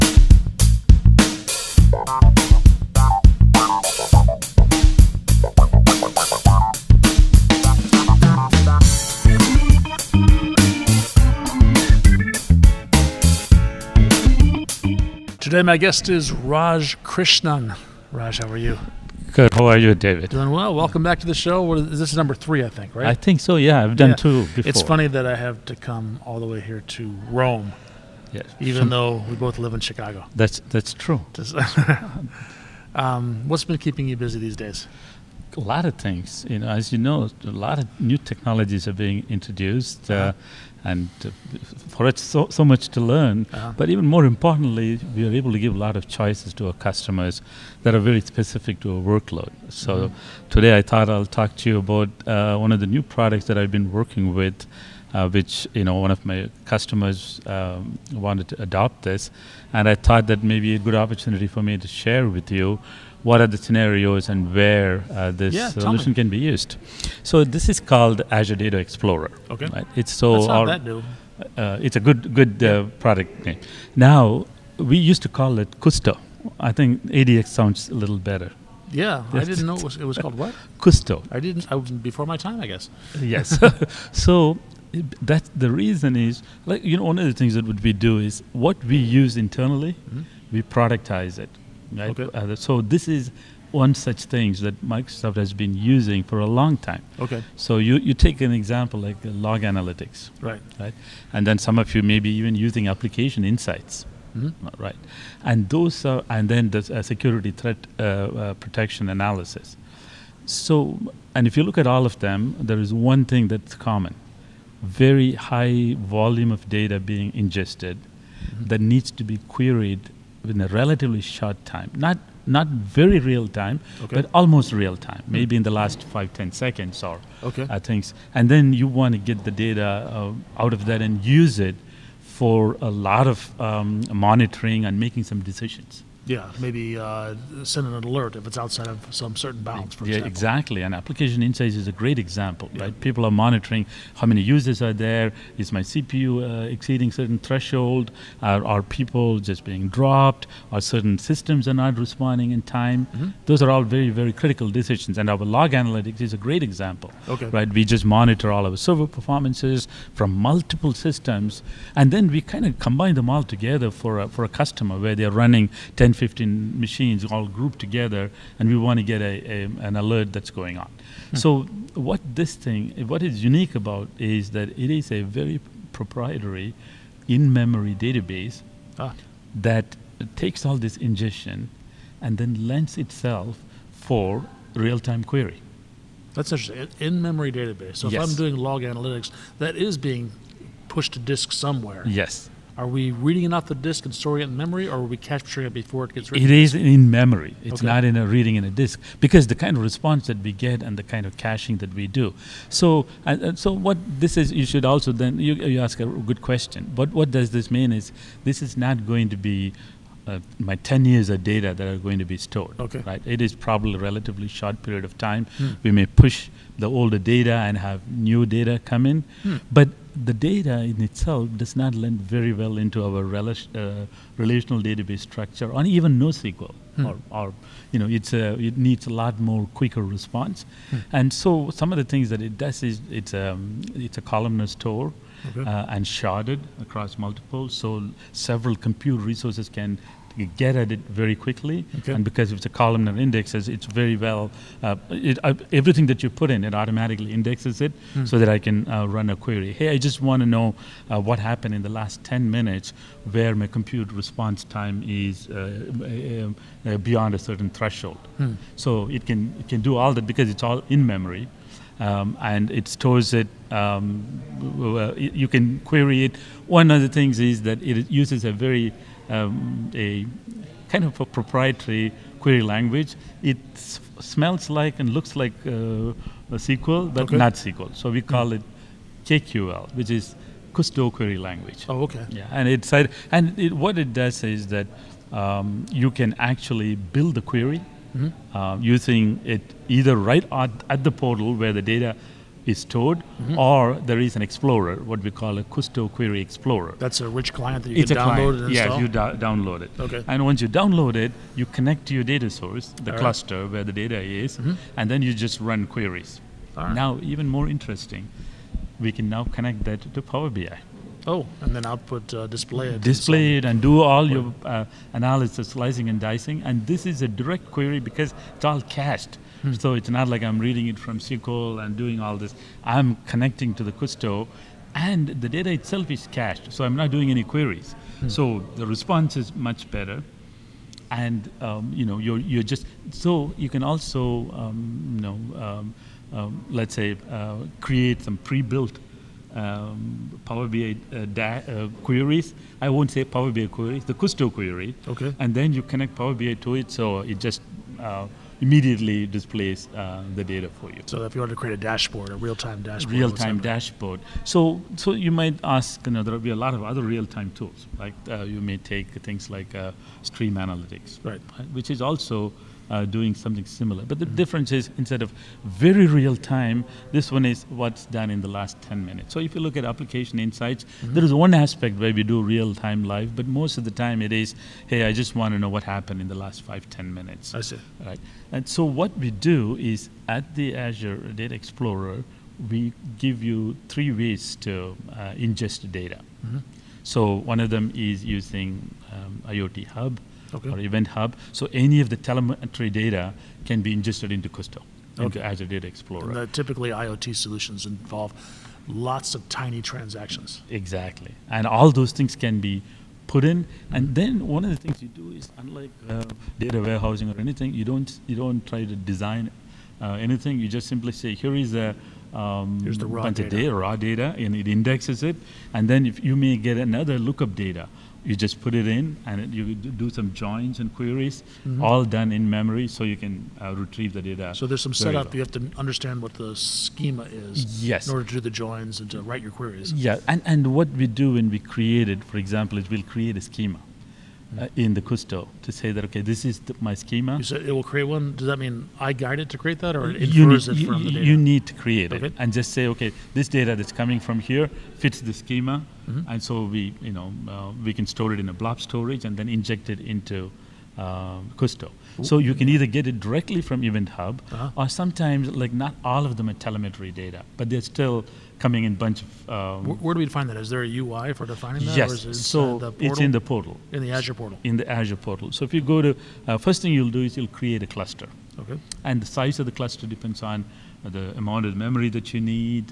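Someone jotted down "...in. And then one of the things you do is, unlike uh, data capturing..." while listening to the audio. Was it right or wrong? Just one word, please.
wrong.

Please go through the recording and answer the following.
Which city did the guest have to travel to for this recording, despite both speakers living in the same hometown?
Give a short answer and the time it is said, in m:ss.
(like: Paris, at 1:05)
Rome, at 0:27.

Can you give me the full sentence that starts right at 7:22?
it and just say okay, this data that's coming from here fits the schema, mm -hmm.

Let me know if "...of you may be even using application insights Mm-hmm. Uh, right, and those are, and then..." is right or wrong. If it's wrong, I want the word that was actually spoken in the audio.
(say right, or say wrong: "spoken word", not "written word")
right.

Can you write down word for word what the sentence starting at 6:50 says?
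You just simply say, here is a um, Here's the raw bunch data.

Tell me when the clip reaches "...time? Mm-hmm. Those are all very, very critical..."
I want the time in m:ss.
2:32.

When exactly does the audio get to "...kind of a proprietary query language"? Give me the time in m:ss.
4:30.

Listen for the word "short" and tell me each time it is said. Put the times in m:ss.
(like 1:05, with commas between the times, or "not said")
2:01, 3:34.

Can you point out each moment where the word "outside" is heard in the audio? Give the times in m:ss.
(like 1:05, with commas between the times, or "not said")
2:18.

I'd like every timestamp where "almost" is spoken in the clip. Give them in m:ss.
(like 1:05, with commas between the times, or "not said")
2:04.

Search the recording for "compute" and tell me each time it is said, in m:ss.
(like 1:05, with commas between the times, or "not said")
3:58, 4:13.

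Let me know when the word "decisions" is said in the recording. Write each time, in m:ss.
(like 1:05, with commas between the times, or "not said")
2:15, 2:34.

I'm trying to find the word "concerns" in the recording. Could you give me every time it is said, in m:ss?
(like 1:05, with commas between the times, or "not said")
not said.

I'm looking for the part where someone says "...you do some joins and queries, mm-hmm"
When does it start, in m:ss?
6:59.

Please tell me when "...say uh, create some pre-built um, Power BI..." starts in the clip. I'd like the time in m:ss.
5:36.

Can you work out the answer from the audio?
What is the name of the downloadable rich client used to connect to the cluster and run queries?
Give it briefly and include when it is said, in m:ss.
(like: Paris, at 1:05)
Kusto Query Explorer, at 4:55.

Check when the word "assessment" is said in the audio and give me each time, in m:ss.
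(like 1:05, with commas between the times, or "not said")
not said.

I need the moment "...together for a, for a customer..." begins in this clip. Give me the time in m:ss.
2:43.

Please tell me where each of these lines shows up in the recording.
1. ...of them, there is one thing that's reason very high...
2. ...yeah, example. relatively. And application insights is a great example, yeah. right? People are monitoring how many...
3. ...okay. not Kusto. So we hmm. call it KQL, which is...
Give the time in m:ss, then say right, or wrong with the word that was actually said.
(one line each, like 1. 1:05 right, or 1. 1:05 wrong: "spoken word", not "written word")
1. 1:52 wrong: "common", not "reason"
2. 2:20 wrong: "exactly", not "relatively"
3. 4:37 wrong: "SQL", not "Kusto".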